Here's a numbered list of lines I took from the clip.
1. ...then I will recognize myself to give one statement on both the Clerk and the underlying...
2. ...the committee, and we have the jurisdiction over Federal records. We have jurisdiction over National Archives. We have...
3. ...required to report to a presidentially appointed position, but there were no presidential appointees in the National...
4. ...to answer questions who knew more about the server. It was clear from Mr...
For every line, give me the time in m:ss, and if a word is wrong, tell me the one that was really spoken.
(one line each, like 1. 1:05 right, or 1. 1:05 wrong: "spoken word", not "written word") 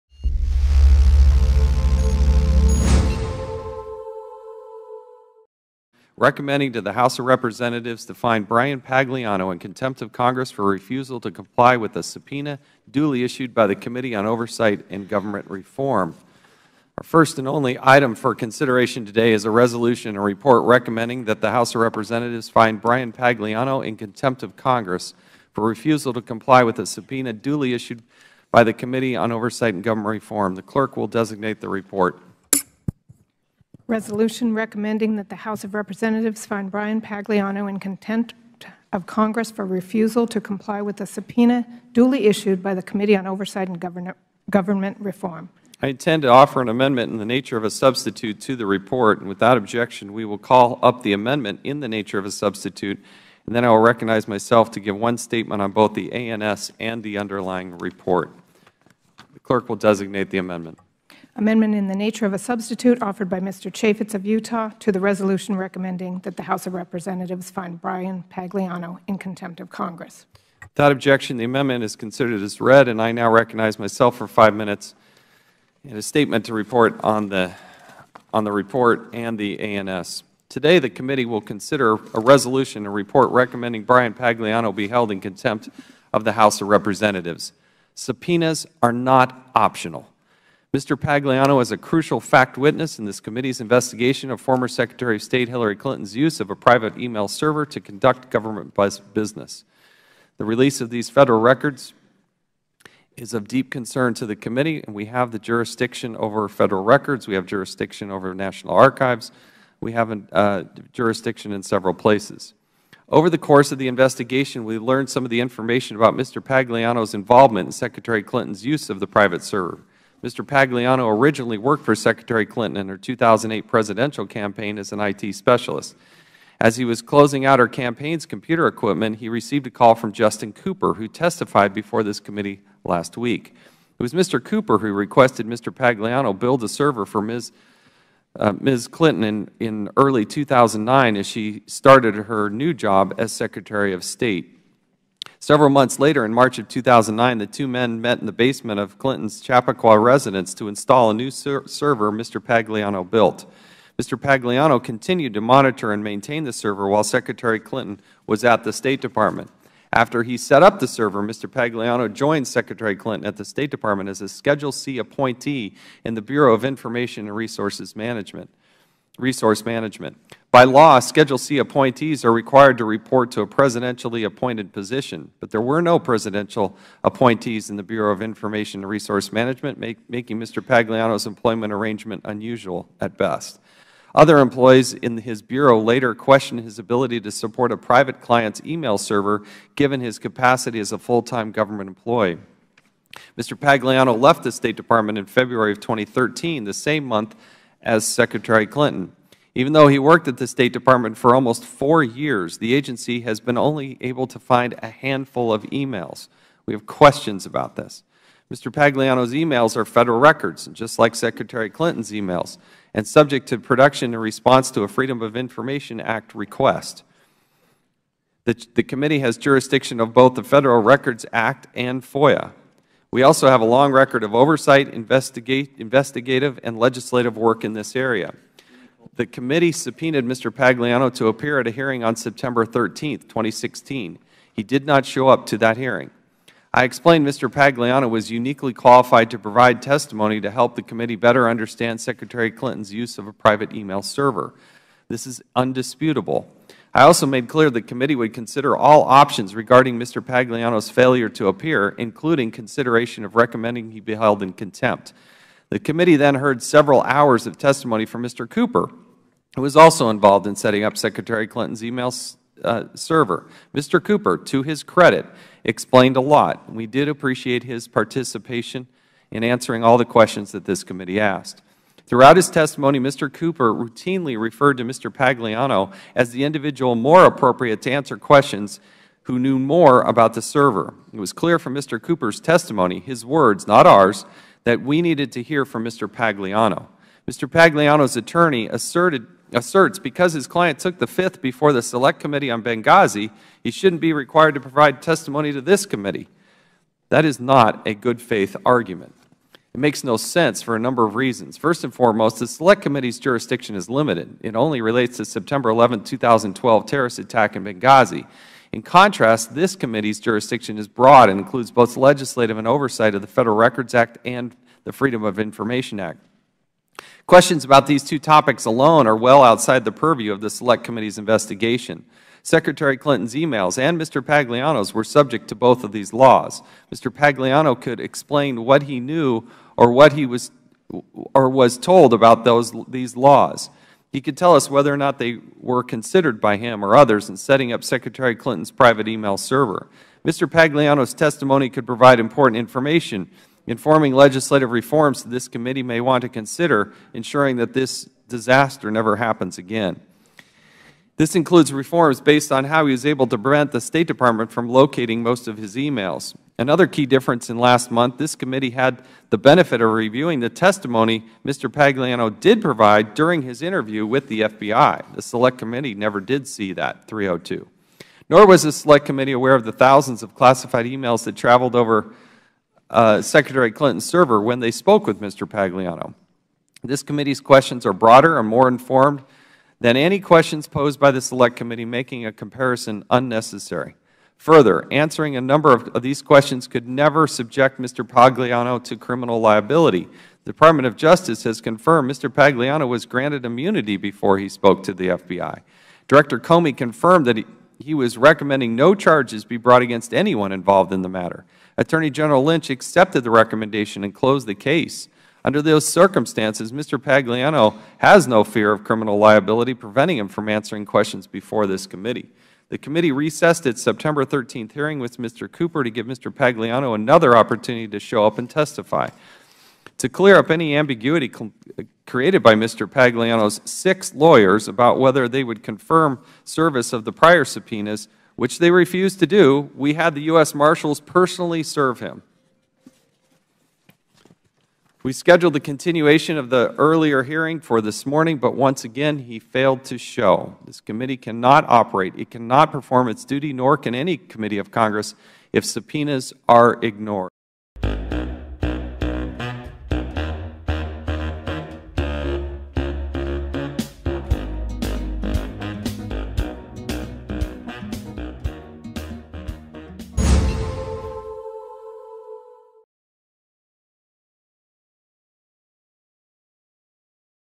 1. 0:53 wrong: "ANS", not "Clerk"
2. 1:44 right
3. 2:52 wrong: "Bureau", not "National"
4. 4:37 right.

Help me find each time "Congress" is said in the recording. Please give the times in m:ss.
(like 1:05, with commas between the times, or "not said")
0:10, 0:24, 0:39, 1:09, 7:24.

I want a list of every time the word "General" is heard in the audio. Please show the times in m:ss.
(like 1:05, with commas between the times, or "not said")
6:42.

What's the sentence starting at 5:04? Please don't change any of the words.
It only relates to September 11, 2012 terrorist attack in Benghazi.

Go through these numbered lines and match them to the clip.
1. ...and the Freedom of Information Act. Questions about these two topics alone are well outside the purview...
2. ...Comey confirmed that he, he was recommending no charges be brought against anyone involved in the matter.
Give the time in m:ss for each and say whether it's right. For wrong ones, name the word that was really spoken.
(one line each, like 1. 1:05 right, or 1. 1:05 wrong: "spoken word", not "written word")
1. 5:14 right
2. 6:36 right.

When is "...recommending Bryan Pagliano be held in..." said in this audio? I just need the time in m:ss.
1:23.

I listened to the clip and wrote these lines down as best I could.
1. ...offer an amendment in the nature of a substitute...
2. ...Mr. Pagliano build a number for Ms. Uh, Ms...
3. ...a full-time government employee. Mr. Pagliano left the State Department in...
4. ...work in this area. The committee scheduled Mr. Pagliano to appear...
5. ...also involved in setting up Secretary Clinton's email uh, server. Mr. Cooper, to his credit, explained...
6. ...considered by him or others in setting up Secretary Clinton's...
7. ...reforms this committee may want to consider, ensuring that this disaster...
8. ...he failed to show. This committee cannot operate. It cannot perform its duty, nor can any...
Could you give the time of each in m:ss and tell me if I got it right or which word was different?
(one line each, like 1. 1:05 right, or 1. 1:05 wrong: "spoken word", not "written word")
1. 0:46 right
2. 2:15 wrong: "server", not "number"
3. 3:10 right
4. 3:47 wrong: "subpoenaed", not "scheduled"
5. 4:19 right
6. 5:35 right
7. 5:44 right
8. 7:19 right.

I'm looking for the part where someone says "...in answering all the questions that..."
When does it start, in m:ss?
4:29.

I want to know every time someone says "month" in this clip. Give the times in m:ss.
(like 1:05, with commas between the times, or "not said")
2:25, 3:17, 5:57.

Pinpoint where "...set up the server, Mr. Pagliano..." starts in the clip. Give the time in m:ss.
2:40.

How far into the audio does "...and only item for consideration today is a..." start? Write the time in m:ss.
0:17.